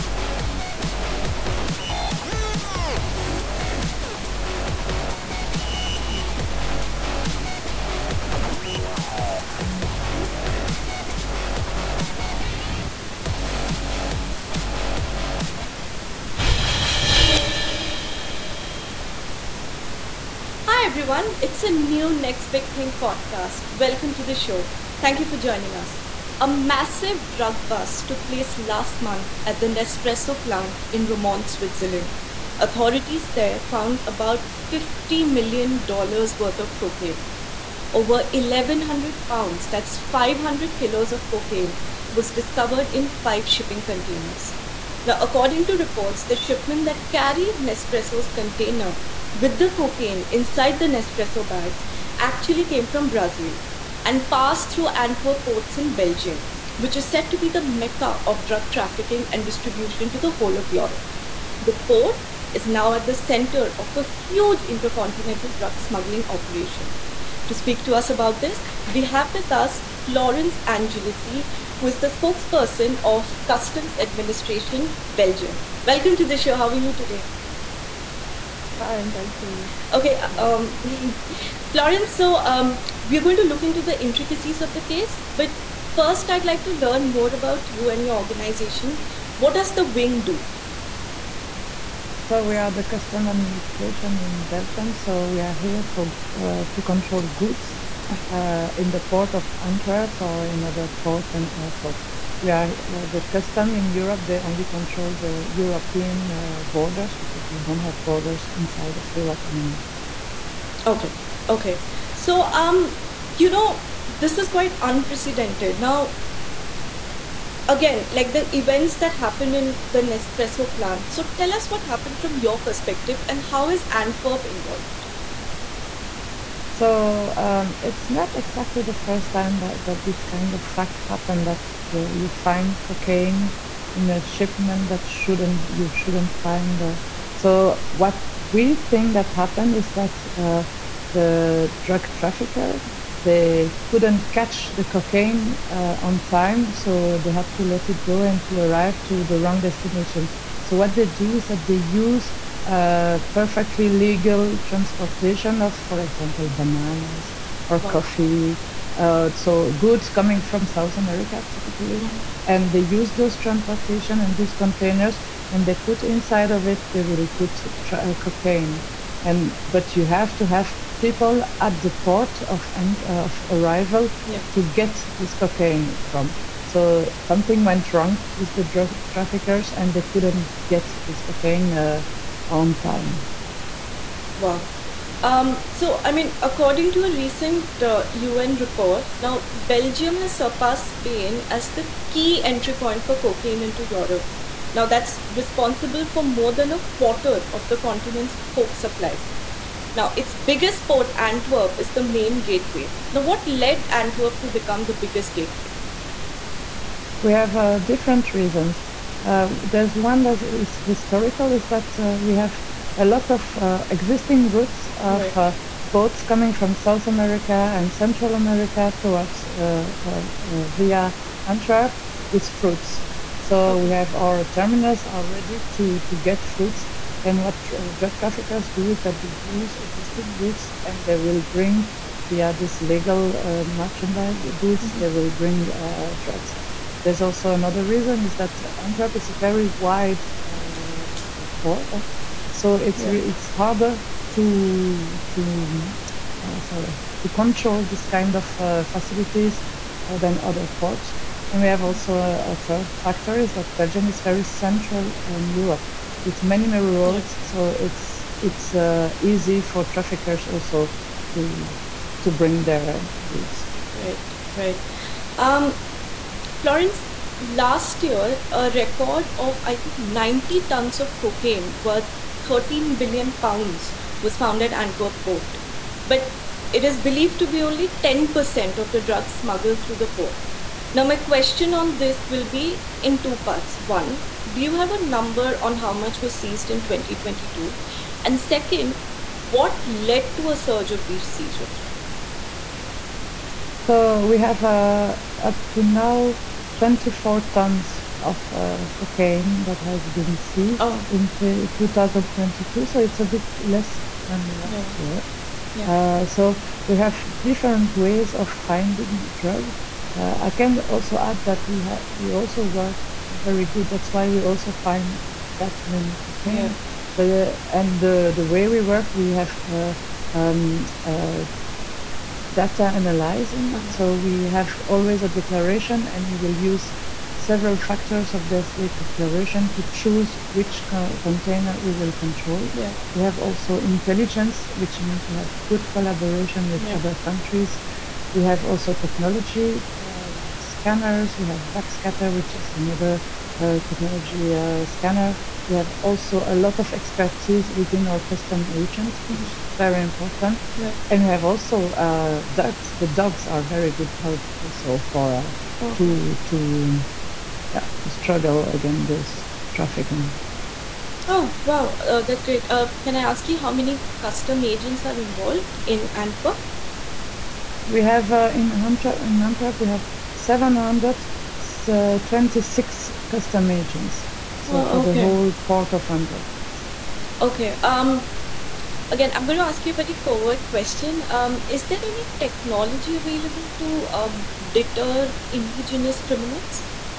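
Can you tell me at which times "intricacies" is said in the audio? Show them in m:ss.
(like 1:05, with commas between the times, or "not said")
1:24.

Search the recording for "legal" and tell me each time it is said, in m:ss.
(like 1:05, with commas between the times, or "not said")
2:33, 3:52.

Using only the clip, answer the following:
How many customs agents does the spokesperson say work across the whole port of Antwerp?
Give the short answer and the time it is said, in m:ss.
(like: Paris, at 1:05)
726, at 6:10.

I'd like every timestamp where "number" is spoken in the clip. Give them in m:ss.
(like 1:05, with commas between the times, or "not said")
4:45.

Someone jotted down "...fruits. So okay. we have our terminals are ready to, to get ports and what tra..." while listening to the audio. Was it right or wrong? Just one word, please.
wrong.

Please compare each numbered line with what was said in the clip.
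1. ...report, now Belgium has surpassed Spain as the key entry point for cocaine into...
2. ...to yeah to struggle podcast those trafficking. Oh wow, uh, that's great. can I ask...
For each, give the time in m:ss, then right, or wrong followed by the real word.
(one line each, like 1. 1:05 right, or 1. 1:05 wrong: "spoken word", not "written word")
1. 3:08 right
2. 5:56 wrong: "against", not "podcast".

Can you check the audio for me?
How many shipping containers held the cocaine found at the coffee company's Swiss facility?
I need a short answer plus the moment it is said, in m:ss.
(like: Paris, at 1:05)
5, at 0:43.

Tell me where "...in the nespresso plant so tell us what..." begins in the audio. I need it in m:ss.
1:59.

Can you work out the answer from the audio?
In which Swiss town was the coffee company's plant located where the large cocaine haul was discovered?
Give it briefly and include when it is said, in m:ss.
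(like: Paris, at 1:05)
Romont, at 0:31.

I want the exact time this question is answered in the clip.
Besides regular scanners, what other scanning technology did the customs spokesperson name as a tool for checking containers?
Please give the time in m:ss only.
5:41.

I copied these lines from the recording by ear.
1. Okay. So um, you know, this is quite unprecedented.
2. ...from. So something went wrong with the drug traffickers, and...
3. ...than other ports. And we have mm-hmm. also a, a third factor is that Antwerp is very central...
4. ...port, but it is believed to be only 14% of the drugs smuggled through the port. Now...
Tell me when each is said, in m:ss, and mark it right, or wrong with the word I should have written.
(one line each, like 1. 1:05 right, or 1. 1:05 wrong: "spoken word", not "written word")
1. 1:51 right
2. 2:56 right
3. 4:10 wrong: "Belgium", not "Antwerp"
4. 4:35 wrong: "10", not "14".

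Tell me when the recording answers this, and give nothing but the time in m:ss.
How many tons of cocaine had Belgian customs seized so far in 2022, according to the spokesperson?
4:56.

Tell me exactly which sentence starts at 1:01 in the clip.
The port is now at the center of a huge intercontinental drug smuggling operation.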